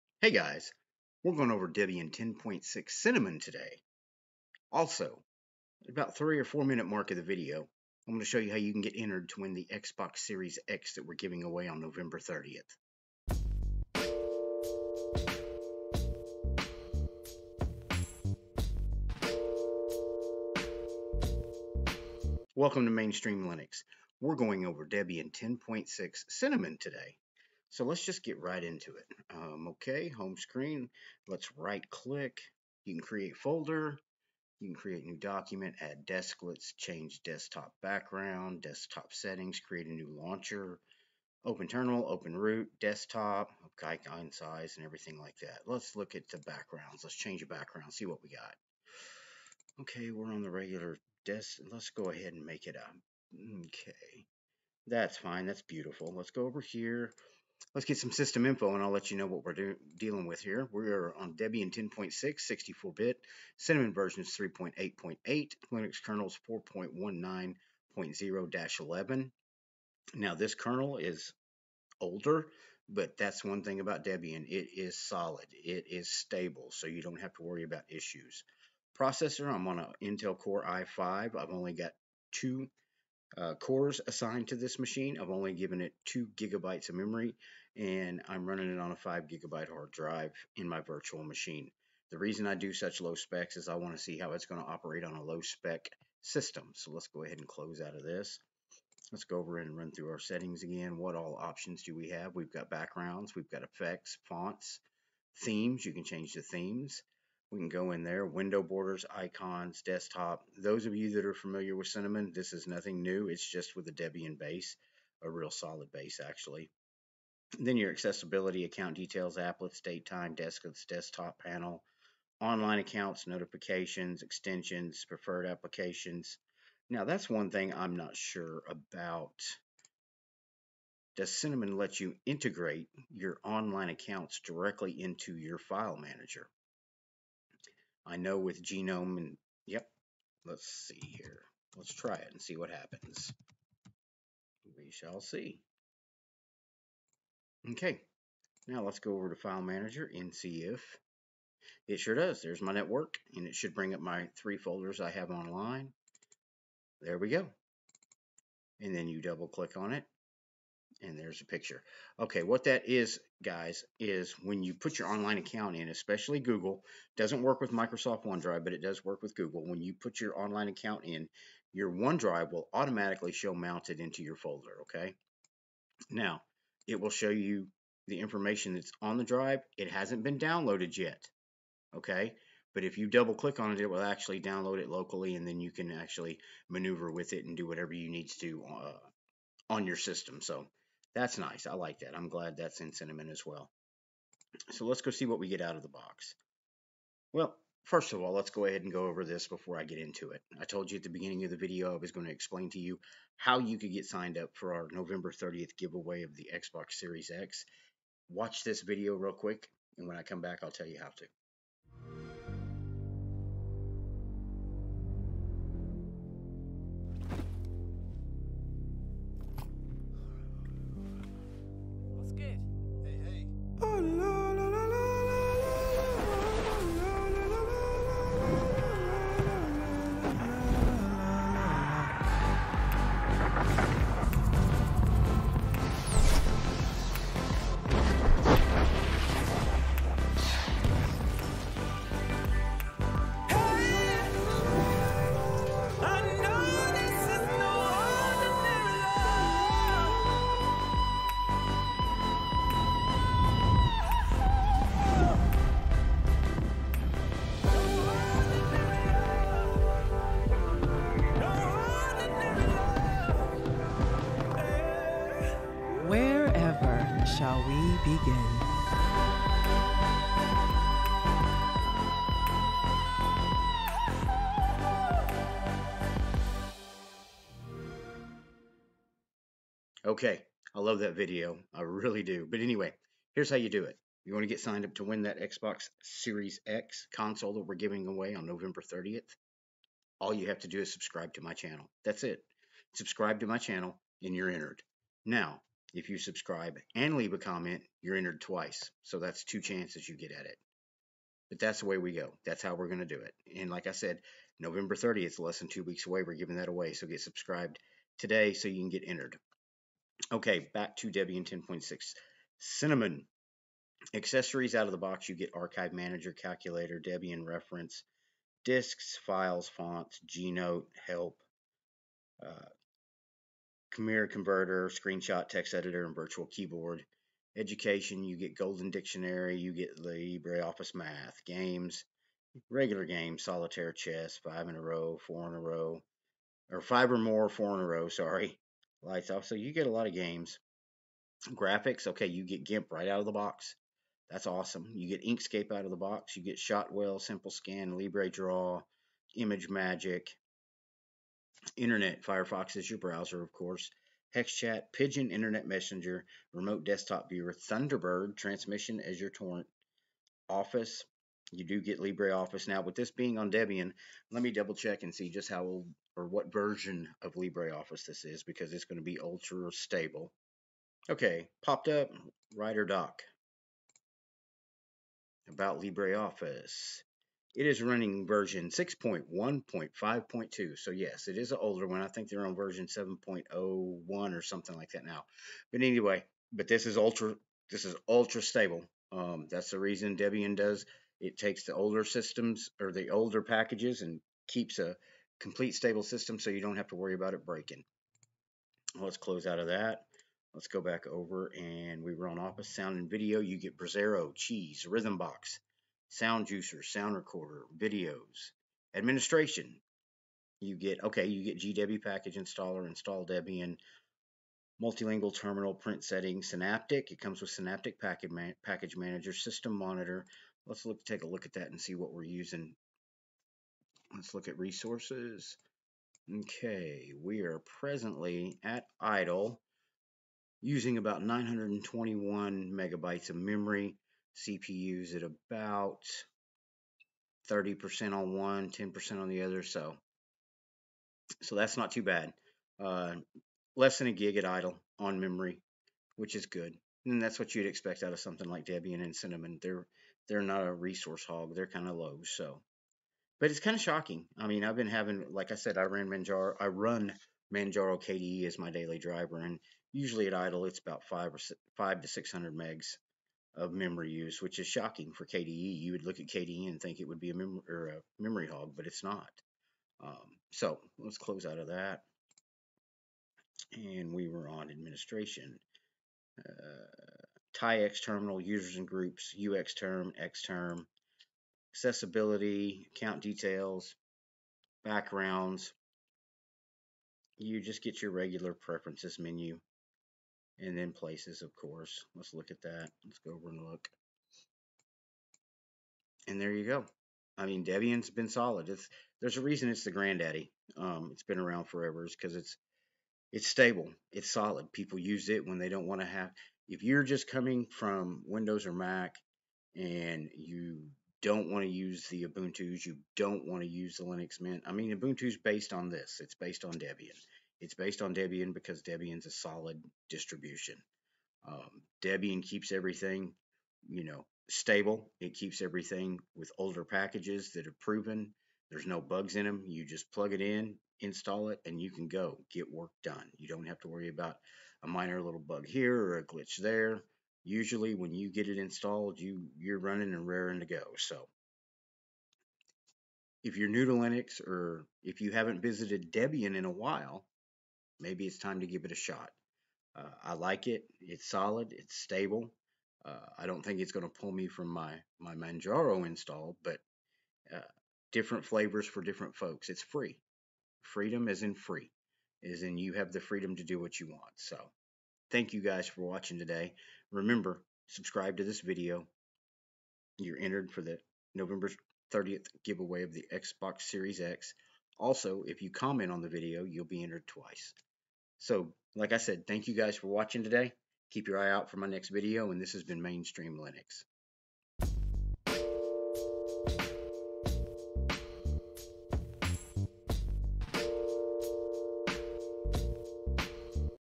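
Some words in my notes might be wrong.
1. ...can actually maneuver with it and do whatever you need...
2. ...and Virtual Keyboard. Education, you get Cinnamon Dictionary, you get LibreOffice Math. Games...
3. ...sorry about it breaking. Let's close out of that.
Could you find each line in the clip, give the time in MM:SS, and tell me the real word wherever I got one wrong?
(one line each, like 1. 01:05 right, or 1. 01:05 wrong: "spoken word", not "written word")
1. 03:05 right
2. 05:26 wrong: "Golden", not "Cinnamon"
3. 06:36 wrong: "worry", not "sorry".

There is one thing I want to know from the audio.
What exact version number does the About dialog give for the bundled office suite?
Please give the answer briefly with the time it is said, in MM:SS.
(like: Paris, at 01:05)
6.1.5.2, at 06:18.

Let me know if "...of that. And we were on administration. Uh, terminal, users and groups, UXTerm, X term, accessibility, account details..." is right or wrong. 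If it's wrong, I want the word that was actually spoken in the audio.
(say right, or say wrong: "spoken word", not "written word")
right.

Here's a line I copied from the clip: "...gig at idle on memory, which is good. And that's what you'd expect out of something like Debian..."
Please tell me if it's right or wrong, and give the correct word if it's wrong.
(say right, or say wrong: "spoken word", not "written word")
right.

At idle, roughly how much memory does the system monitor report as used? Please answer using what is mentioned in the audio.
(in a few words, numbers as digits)
921 megabytes.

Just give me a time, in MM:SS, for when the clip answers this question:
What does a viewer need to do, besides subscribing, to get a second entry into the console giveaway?
04:57.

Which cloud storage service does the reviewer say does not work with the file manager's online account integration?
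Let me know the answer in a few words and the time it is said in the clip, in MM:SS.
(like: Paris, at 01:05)
Microsoft OneDrive, at 02:47.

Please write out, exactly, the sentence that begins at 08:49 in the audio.
You just plug it in, install it, and you can go get work done.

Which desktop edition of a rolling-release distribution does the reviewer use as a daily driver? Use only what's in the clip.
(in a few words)
Manjaro KDE.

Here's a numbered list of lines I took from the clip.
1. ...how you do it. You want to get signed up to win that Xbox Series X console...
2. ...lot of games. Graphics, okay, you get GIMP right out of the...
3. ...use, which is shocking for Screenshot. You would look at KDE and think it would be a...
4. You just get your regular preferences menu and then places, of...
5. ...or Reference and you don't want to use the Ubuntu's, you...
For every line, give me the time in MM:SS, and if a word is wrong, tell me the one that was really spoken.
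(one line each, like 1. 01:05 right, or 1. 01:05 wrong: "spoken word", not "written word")
1. 04:43 right
2. 05:39 right
3. 07:44 wrong: "KDE", not "Screenshot"
4. 08:07 right
5. 08:28 wrong: "Mac", not "Reference".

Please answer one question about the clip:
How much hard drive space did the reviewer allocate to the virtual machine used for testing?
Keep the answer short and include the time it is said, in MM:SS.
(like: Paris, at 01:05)
5 gigabytes, at 01:28.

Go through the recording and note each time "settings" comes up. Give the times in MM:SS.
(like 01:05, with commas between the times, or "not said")
00:39, 01:40, 06:56.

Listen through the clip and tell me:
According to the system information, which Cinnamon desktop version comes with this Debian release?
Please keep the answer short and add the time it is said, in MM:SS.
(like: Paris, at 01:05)
3.8.8, at 01:03.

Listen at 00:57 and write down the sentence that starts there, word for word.
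Let's get some system info and I'll let you know what we're dealing with here.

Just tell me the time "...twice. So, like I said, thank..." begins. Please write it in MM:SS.
09:37.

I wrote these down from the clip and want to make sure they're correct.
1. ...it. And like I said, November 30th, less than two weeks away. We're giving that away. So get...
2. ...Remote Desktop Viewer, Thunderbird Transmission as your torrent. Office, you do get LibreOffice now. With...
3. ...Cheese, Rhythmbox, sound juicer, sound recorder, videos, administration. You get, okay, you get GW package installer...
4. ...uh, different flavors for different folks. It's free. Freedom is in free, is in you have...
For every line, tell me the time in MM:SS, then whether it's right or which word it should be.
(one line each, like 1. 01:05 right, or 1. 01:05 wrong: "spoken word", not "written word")
1. 05:03 right
2. 05:56 right
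3. 06:44 right
4. 09:17 right.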